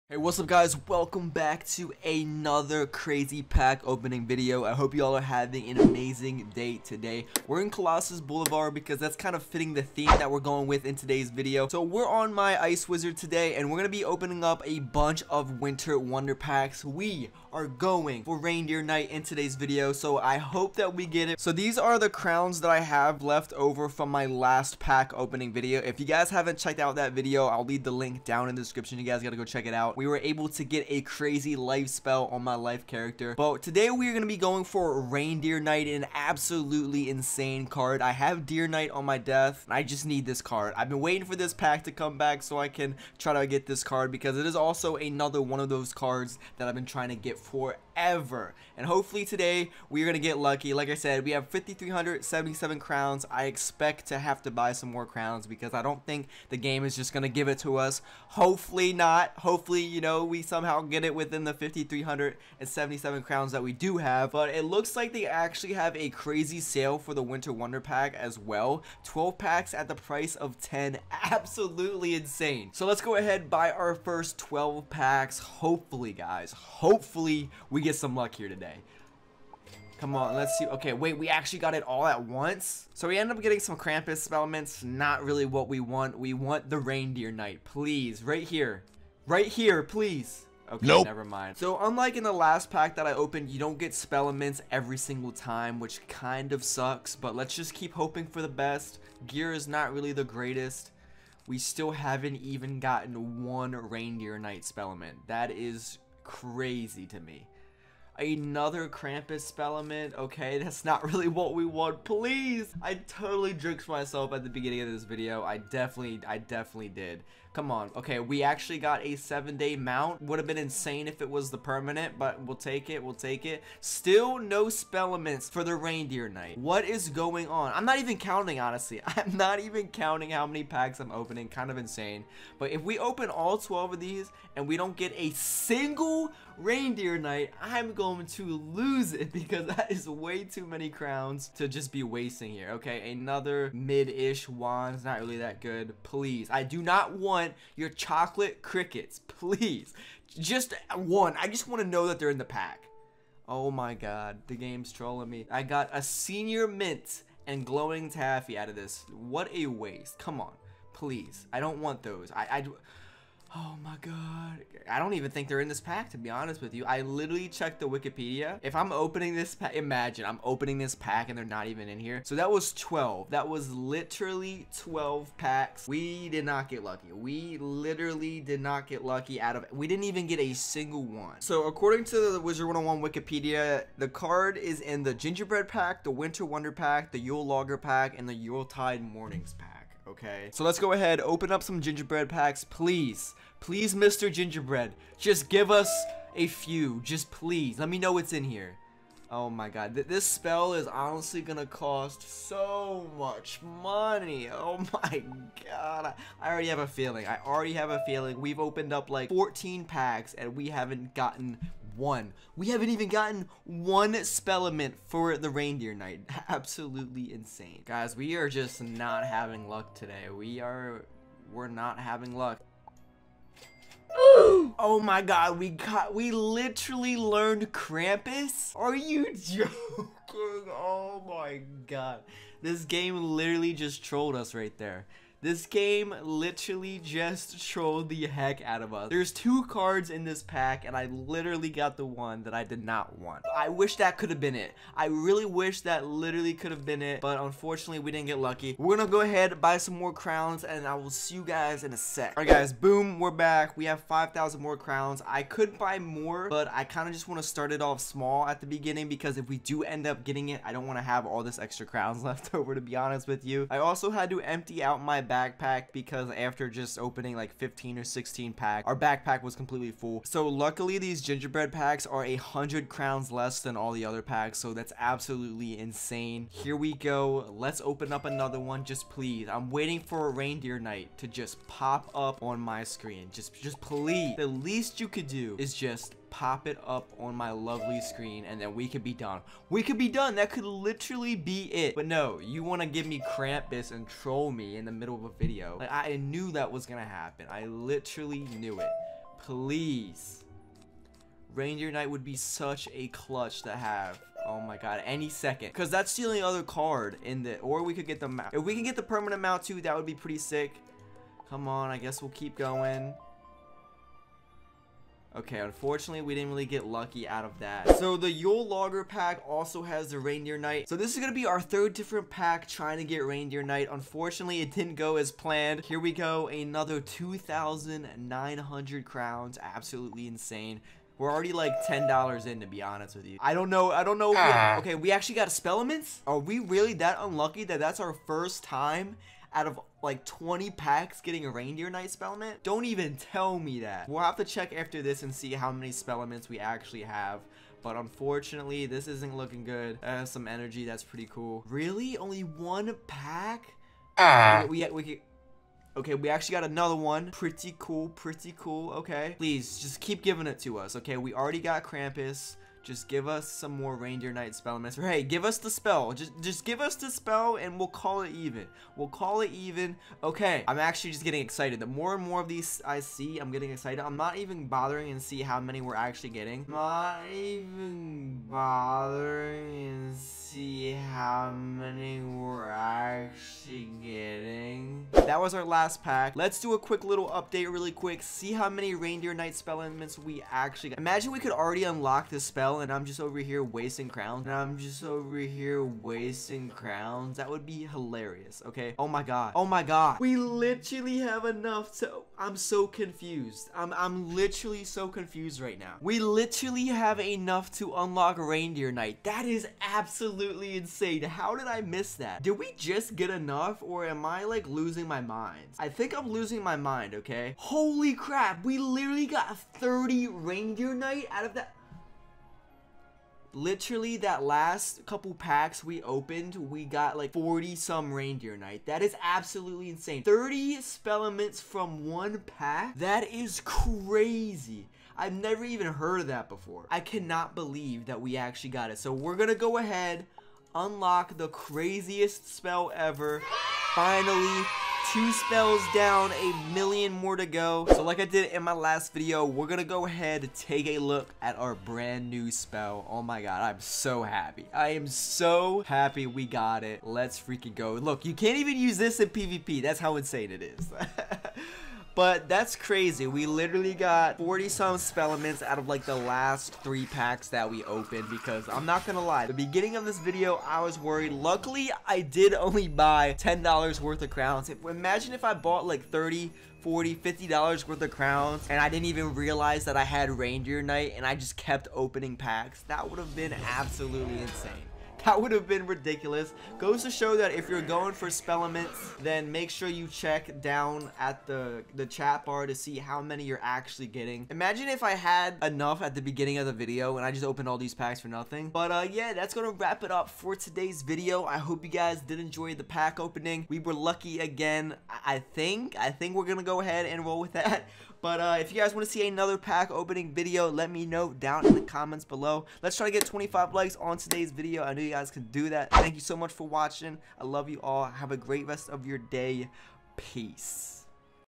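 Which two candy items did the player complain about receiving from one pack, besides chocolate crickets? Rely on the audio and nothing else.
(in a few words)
Senior mint and glowing taffy.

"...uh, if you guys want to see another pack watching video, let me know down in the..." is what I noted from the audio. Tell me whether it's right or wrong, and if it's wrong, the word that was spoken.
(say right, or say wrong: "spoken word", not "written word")
wrong: "opening", not "watching".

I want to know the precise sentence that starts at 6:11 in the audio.
The more and more of these I see, I'm getting excited.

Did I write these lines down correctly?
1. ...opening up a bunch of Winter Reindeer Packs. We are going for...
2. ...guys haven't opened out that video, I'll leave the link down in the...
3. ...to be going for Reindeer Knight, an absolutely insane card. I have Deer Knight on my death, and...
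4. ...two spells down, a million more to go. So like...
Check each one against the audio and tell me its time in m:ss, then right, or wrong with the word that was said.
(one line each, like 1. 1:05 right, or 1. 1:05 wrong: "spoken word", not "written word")
1. 0:14 wrong: "Wonder", not "Reindeer"
2. 0:26 wrong: "checked", not "opened"
3. 0:34 right
4. 7:25 right.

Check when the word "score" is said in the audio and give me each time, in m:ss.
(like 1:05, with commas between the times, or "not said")
not said.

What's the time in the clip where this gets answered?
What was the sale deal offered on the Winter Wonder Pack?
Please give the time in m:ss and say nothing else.
1:09.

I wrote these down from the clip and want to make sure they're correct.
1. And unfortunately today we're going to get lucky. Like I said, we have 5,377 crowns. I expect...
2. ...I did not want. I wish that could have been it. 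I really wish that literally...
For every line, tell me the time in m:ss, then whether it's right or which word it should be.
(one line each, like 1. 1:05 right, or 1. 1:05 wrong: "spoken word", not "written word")
1. 0:48 wrong: "hopefully", not "unfortunately"
2. 4:02 right.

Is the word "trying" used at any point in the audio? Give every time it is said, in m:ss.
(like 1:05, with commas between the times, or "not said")
0:46, 5:22.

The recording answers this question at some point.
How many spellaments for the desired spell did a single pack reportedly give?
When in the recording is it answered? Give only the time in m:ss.
7:10.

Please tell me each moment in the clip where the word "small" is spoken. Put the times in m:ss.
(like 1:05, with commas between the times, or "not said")
4:17.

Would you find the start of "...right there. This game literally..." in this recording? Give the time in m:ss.
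3:54.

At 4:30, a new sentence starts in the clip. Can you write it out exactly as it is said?
So luckily these gingerbread packs are a hundred crowns less than all the other packs.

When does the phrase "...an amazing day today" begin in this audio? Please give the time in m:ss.
0:05.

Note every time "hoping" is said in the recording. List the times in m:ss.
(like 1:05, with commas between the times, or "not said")
1:37.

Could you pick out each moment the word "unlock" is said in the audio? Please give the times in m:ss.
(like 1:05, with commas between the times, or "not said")
6:31, 6:47, 7:20.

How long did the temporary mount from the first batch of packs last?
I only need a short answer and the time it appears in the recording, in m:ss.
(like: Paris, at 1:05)
7-day, at 1:59.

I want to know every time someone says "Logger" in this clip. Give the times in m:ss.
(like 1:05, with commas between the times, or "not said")
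3:07, 5:18.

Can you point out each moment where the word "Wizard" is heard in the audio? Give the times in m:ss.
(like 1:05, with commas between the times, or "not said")
0:12, 3:02.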